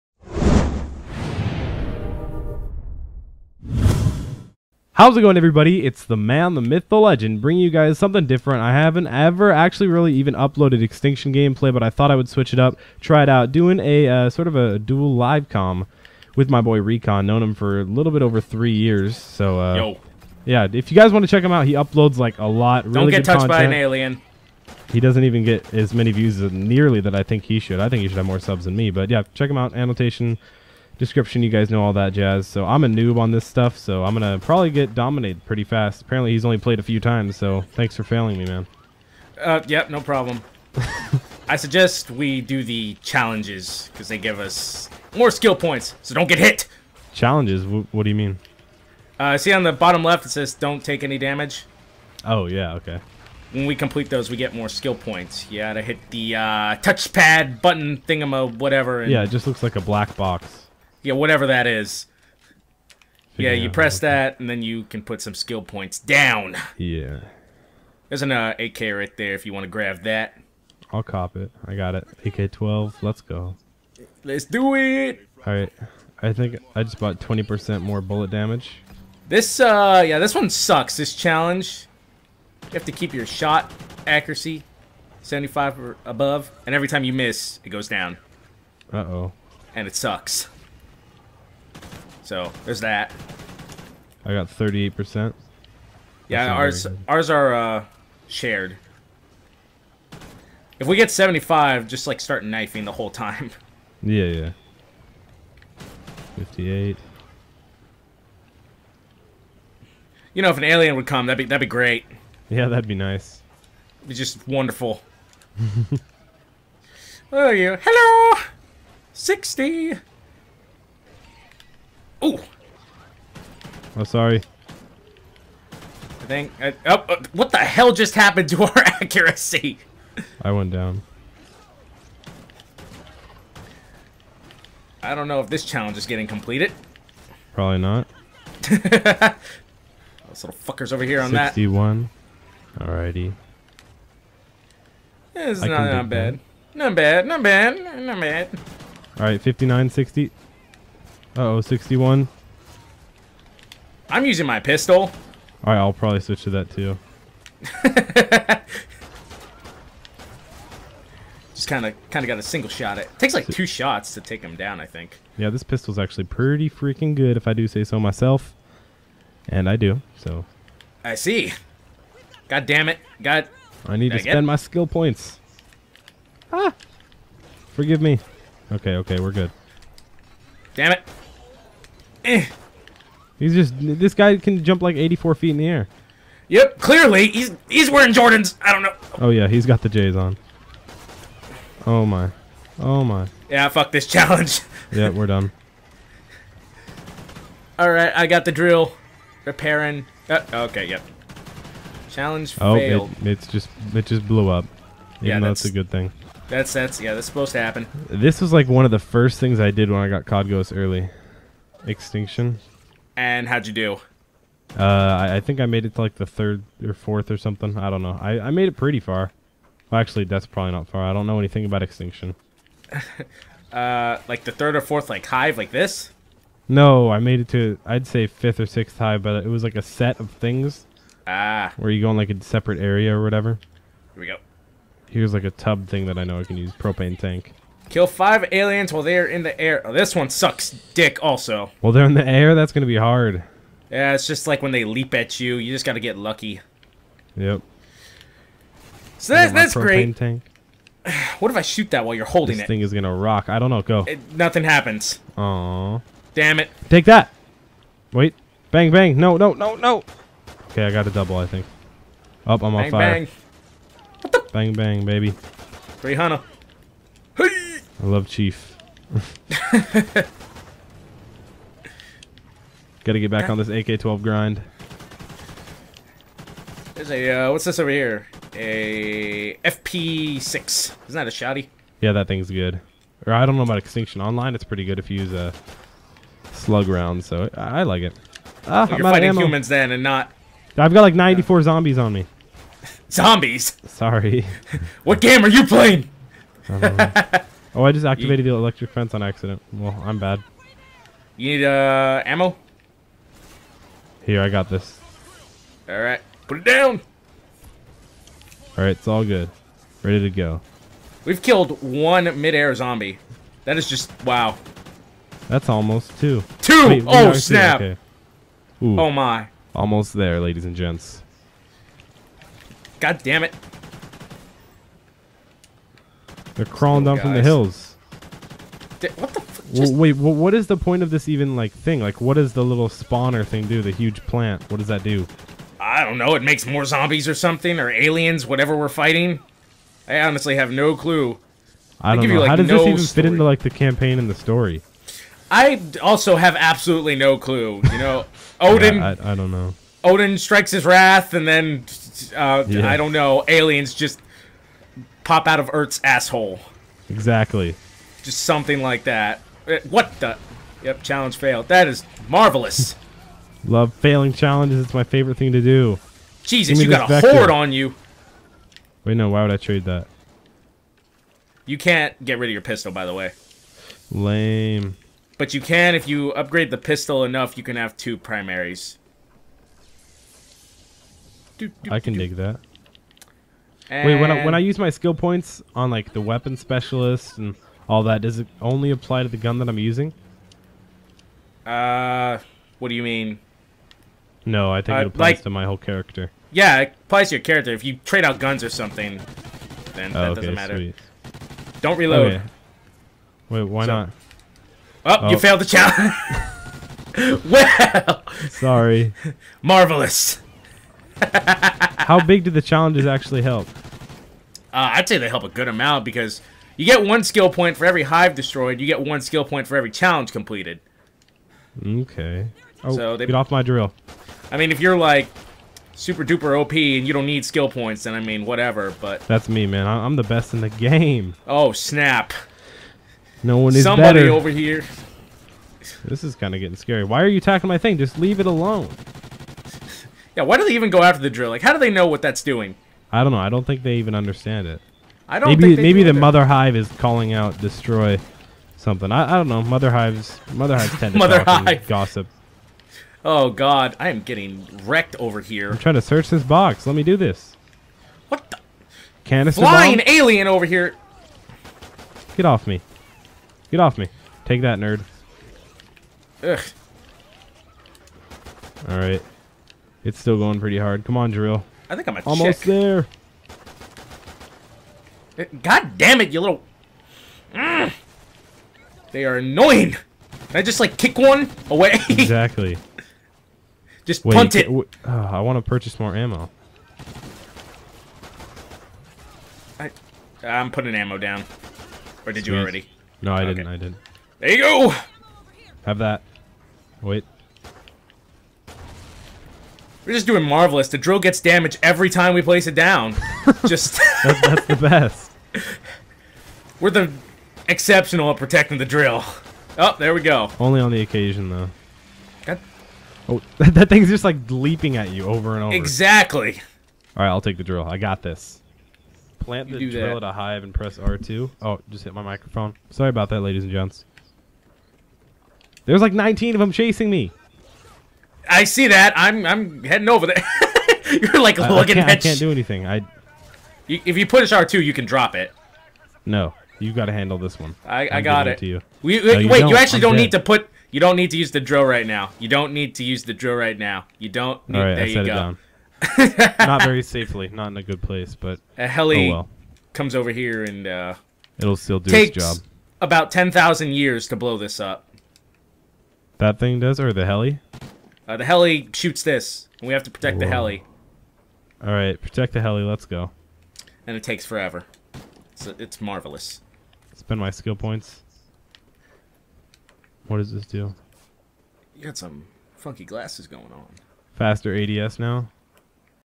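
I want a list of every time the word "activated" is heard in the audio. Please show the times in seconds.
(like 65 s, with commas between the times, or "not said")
298 s.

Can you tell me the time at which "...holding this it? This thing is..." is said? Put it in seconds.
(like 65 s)
252 s.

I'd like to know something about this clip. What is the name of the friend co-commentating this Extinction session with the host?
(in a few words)
Reacon.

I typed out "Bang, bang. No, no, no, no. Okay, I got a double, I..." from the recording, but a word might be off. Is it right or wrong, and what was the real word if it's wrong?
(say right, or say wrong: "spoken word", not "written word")
right.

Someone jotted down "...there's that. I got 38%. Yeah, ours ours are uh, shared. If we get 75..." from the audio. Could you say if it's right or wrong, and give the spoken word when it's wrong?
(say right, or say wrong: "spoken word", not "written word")
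right.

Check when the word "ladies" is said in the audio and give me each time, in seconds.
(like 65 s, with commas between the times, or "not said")
320 s, 523 s.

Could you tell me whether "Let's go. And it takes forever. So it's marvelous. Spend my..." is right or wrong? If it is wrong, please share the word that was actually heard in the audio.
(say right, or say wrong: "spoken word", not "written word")
right.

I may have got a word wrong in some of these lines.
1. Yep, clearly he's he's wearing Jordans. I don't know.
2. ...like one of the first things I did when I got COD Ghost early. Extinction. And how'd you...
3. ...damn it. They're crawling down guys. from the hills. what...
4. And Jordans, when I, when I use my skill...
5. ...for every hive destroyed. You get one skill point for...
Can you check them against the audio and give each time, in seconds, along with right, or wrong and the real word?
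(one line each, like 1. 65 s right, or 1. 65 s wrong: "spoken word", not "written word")
1. 186 s right
2. 208 s right
3. 323 s right
4. 383 s wrong: "Wait", not "Jordans"
5. 417 s right.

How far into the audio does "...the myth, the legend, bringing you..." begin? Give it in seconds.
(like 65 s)
6 s.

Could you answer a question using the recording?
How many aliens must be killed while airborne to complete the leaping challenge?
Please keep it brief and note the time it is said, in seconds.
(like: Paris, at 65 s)
five, at 238 s.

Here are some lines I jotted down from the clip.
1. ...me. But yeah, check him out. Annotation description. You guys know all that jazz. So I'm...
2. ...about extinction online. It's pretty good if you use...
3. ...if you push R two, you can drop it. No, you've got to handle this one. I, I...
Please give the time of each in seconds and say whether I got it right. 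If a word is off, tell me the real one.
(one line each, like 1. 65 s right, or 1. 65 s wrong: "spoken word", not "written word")
1. 28 s right
2. 283 s right
3. 534 s right.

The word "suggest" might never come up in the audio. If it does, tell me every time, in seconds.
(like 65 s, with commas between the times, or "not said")
41 s.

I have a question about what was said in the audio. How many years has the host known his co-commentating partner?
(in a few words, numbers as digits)
three years.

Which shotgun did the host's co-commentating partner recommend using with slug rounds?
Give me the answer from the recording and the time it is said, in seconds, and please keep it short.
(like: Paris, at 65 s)
FP6, at 279 s.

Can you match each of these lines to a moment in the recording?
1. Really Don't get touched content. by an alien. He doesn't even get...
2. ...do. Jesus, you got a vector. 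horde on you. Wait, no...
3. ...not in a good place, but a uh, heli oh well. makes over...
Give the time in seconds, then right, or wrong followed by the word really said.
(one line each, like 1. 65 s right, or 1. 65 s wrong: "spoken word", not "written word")
1. 22 s right
2. 365 s right
3. 547 s wrong: "comes", not "makes".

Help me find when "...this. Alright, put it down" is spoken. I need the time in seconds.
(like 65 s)
304 s.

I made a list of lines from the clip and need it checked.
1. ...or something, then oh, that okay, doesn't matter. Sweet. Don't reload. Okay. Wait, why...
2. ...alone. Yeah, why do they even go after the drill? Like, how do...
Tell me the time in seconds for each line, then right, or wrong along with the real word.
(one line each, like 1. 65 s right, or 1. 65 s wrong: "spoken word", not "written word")
1. 398 s right
2. 438 s right.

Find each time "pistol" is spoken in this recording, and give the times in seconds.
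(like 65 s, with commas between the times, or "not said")
154 s, 165 s, 372 s, 376 s.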